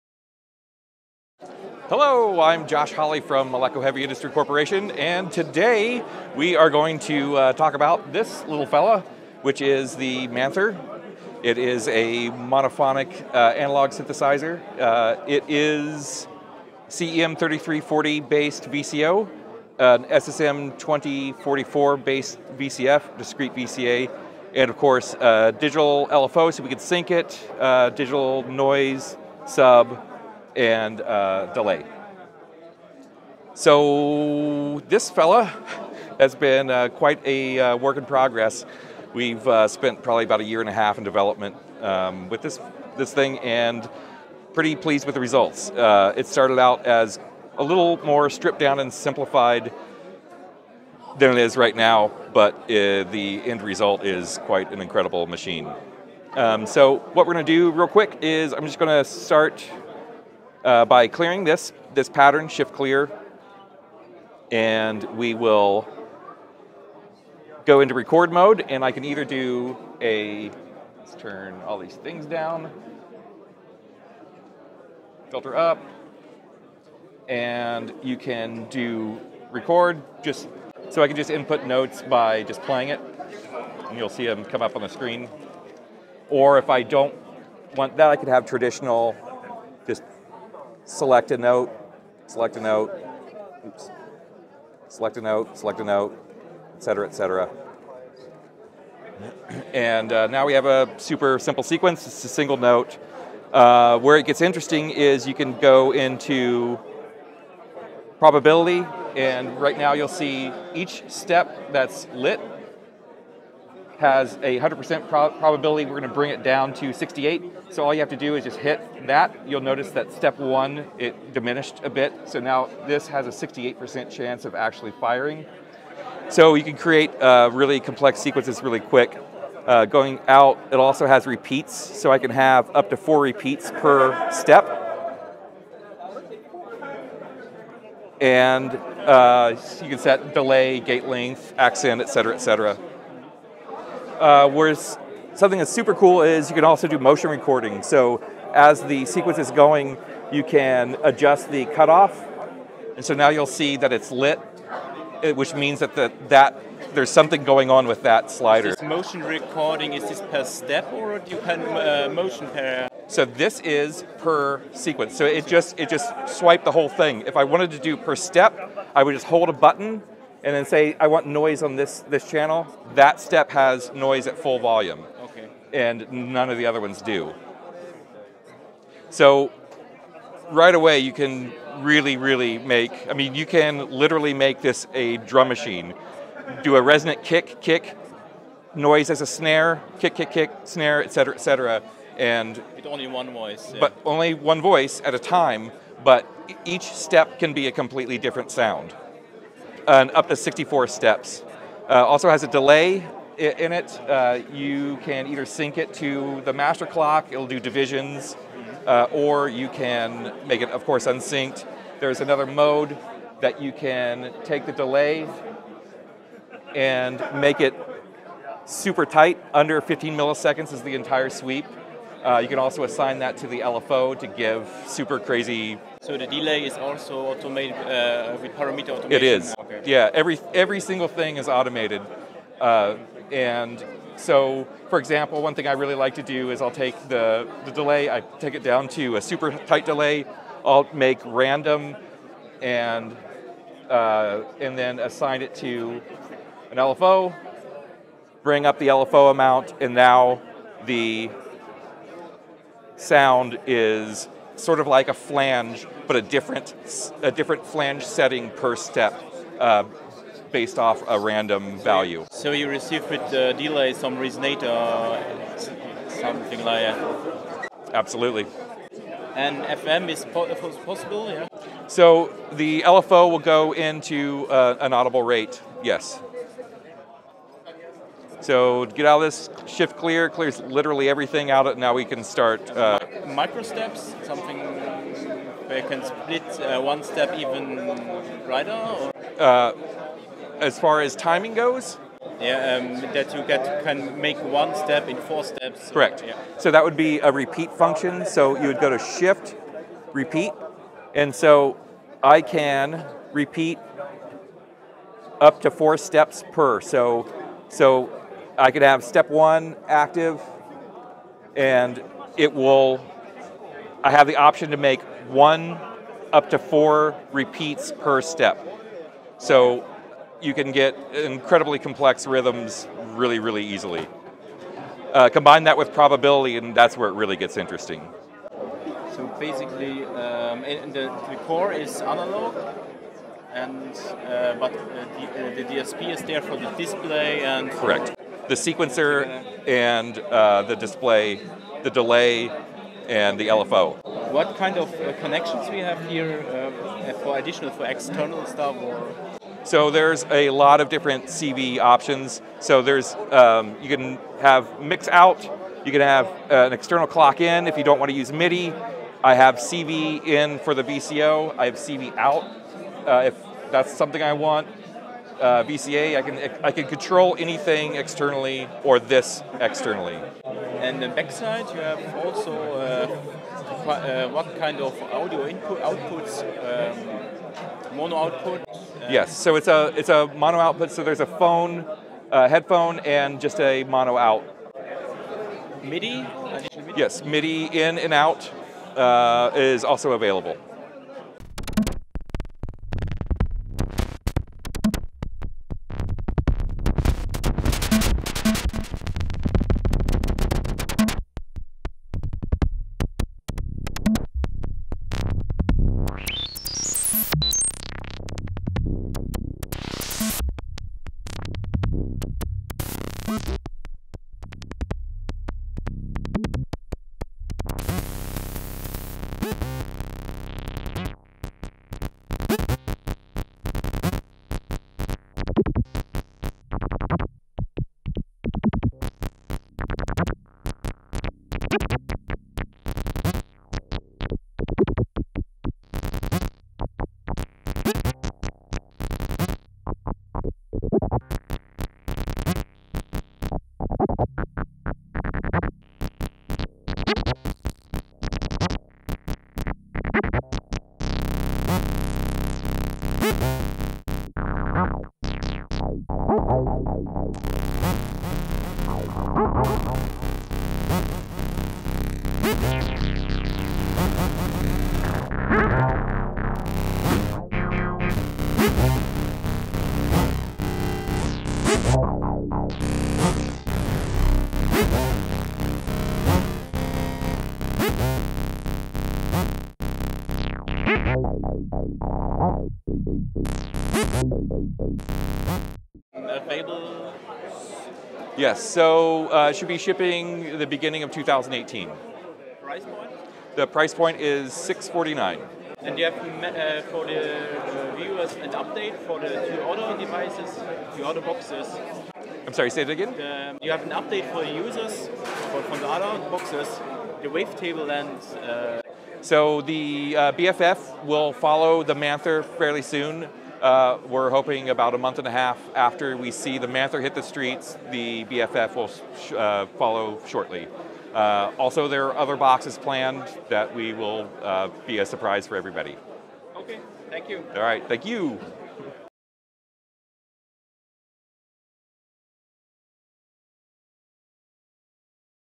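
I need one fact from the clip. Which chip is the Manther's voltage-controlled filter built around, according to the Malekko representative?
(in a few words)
SSM2044.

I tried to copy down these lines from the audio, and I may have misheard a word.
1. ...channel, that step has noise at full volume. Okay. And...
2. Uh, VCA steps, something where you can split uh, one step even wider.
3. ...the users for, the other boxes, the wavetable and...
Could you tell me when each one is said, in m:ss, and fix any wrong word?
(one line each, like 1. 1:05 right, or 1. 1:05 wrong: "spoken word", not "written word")
1. 2:52 right
2. 4:42 wrong: "Micro", not "VCA"
3. 8:24 right.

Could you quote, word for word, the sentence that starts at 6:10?
And the backside, you have also uh, uh what kind of audio input outputs, um, mono output.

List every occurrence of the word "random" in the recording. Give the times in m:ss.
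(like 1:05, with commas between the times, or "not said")
4:01, 4:21.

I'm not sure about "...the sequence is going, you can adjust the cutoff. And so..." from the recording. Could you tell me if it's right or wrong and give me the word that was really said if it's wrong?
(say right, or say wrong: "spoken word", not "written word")
right.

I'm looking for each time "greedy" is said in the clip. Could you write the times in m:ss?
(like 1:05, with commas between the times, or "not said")
not said.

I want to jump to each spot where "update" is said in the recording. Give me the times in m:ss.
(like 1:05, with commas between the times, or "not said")
8:18, 8:23.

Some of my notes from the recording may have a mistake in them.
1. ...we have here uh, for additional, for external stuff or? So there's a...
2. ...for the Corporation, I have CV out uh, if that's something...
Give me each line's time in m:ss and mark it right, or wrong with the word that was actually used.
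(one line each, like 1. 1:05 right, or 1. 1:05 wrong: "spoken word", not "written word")
1. 5:45 right
2. 6:00 wrong: "VCO", not "Corporation".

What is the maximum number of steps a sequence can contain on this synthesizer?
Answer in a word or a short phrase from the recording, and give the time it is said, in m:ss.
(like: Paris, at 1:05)
64, at 3:20.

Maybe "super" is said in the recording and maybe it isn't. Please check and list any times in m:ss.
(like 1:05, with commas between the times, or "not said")
1:40, 2:25, 3:38, 3:44, 3:59.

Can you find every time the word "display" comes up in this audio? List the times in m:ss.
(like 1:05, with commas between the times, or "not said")
5:36, 5:40.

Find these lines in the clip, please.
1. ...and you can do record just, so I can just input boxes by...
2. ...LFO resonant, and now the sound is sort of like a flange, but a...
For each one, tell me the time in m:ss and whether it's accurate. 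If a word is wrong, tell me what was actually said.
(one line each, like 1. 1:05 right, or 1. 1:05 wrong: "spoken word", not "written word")
1. 1:17 wrong: "notes", not "boxes"
2. 4:08 wrong: "amount", not "resonant".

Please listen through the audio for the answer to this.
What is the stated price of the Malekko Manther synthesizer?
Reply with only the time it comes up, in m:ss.
8:14.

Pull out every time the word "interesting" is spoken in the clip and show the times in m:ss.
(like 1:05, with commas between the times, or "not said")
1:44, 5:27.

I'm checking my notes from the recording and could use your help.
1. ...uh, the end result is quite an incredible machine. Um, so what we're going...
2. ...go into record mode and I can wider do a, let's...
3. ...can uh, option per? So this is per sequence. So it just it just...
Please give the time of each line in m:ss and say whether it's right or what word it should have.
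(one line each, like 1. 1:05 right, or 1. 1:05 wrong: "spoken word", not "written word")
1. 0:52 right
2. 1:07 wrong: "either", not "wider"
3. 2:41 wrong: "motion", not "option".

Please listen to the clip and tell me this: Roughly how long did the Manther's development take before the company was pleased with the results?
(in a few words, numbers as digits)
a year and a half.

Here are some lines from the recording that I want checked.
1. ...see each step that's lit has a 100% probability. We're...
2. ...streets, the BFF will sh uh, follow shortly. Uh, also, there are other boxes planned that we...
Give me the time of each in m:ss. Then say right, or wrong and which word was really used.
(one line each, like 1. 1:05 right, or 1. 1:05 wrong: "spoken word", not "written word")
1. 1:50 right
2. 8:37 right.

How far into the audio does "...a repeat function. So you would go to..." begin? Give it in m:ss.
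4:57.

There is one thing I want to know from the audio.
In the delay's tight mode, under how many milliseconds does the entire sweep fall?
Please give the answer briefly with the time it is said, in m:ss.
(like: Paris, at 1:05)
15, at 3:39.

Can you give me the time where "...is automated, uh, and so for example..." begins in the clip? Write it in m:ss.
3:51.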